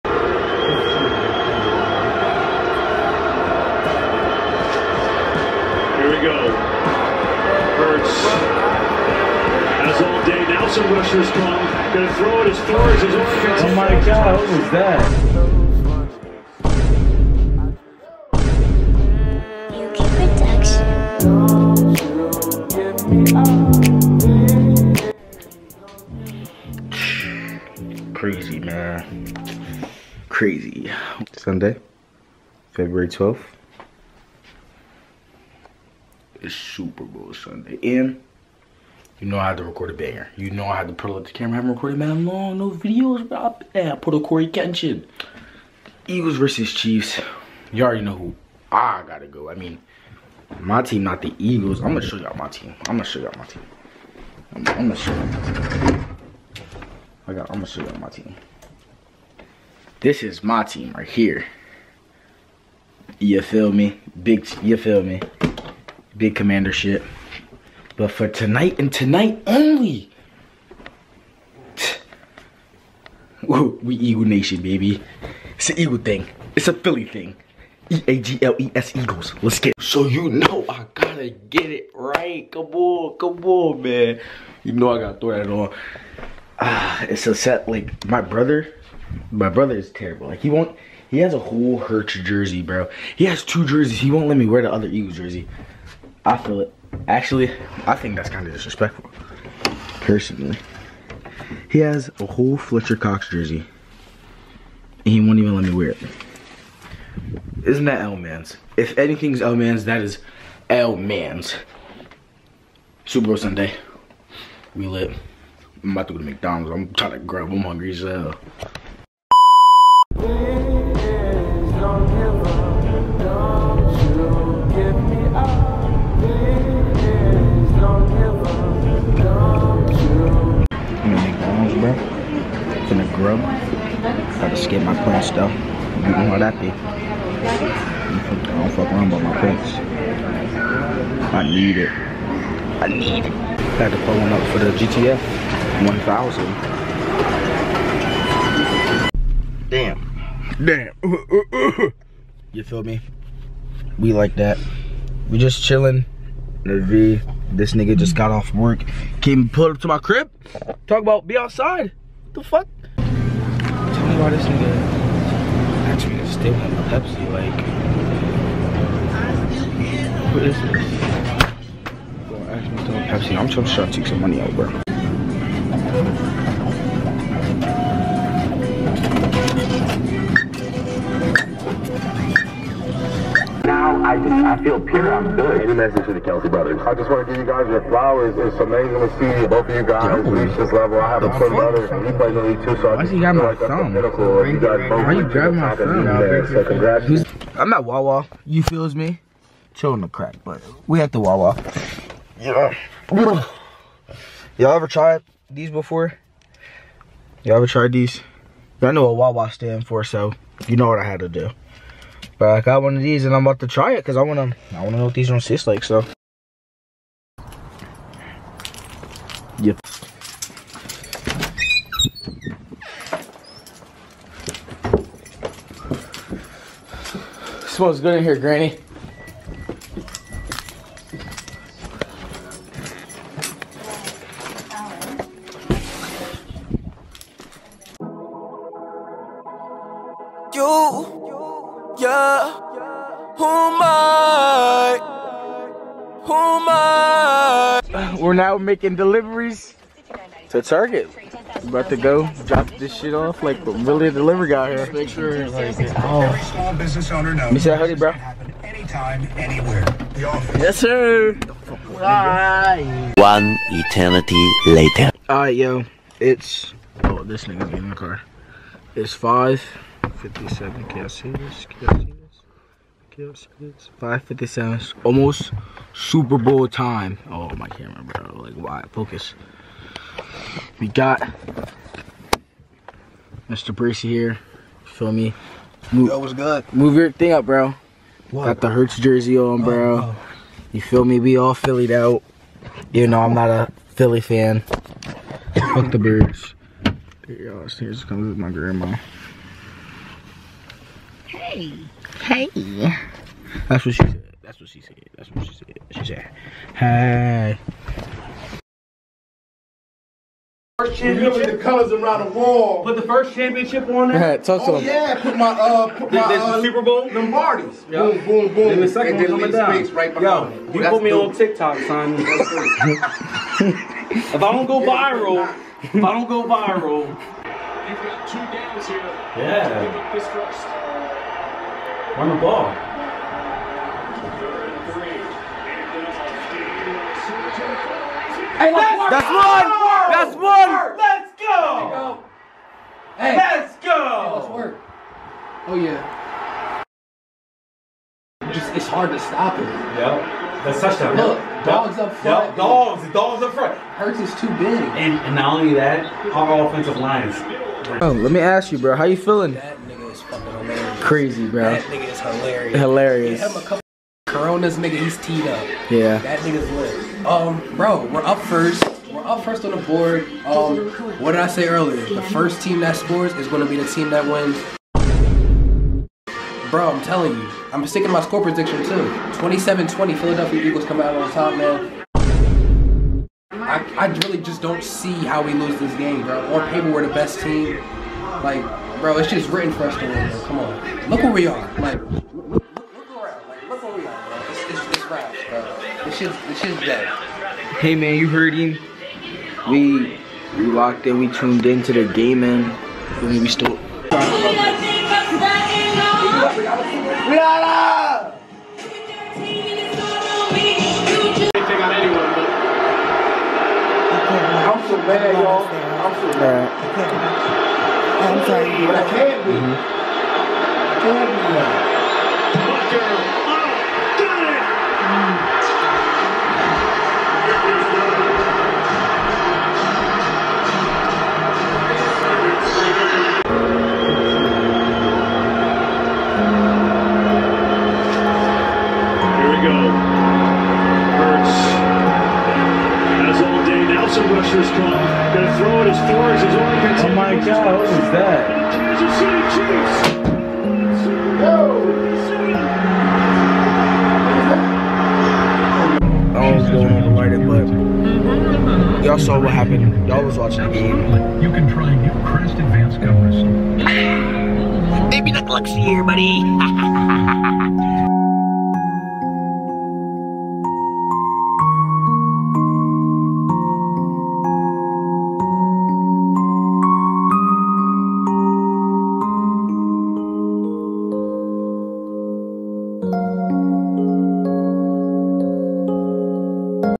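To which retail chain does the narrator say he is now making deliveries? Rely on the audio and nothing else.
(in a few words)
Target.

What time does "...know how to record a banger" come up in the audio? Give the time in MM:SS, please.
00:39.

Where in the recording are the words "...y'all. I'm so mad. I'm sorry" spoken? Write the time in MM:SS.
06:55.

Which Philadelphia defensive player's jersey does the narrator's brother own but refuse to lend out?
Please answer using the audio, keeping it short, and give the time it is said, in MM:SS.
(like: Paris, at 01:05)
Fletcher Cox, at 01:42.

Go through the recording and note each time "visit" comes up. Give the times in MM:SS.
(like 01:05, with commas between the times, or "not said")
not said.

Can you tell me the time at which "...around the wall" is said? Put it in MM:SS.
05:11.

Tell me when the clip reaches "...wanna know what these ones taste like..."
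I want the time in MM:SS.
03:34.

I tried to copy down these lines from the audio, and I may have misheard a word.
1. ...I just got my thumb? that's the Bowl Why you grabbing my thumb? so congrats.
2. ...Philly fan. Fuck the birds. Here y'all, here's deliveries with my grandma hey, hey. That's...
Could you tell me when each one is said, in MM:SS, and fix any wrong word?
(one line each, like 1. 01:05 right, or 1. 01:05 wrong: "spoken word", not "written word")
1. 03:12 wrong: "You", not "Bowl"
2. 04:53 wrong: "comes", not "deliveries".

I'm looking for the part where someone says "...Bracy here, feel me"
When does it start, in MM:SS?
04:43.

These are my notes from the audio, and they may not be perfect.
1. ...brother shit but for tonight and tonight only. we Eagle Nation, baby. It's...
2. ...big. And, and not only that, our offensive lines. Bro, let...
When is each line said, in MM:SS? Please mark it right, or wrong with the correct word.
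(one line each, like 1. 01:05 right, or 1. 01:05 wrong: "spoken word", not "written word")
1. 01:06 wrong: "commander", not "brother"
2. 05:54 right.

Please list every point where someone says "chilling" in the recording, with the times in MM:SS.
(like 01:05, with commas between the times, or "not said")
02:35, 03:19.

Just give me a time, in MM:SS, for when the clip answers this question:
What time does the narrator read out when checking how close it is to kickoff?
04:29.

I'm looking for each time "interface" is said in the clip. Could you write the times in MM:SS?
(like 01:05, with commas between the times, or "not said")
not said.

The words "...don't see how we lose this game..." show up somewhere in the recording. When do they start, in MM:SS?
06:24.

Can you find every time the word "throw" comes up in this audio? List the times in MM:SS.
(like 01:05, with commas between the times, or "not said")
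00:12, 01:25, 07:25.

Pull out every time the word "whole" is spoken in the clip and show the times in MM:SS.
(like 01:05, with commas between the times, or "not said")
01:31, 01:42.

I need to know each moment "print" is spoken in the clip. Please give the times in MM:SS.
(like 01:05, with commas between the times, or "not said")
02:15, 02:19.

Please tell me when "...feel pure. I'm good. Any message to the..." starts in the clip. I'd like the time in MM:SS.
03:04.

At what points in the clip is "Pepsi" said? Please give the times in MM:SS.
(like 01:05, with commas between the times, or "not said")
02:46, 02:53.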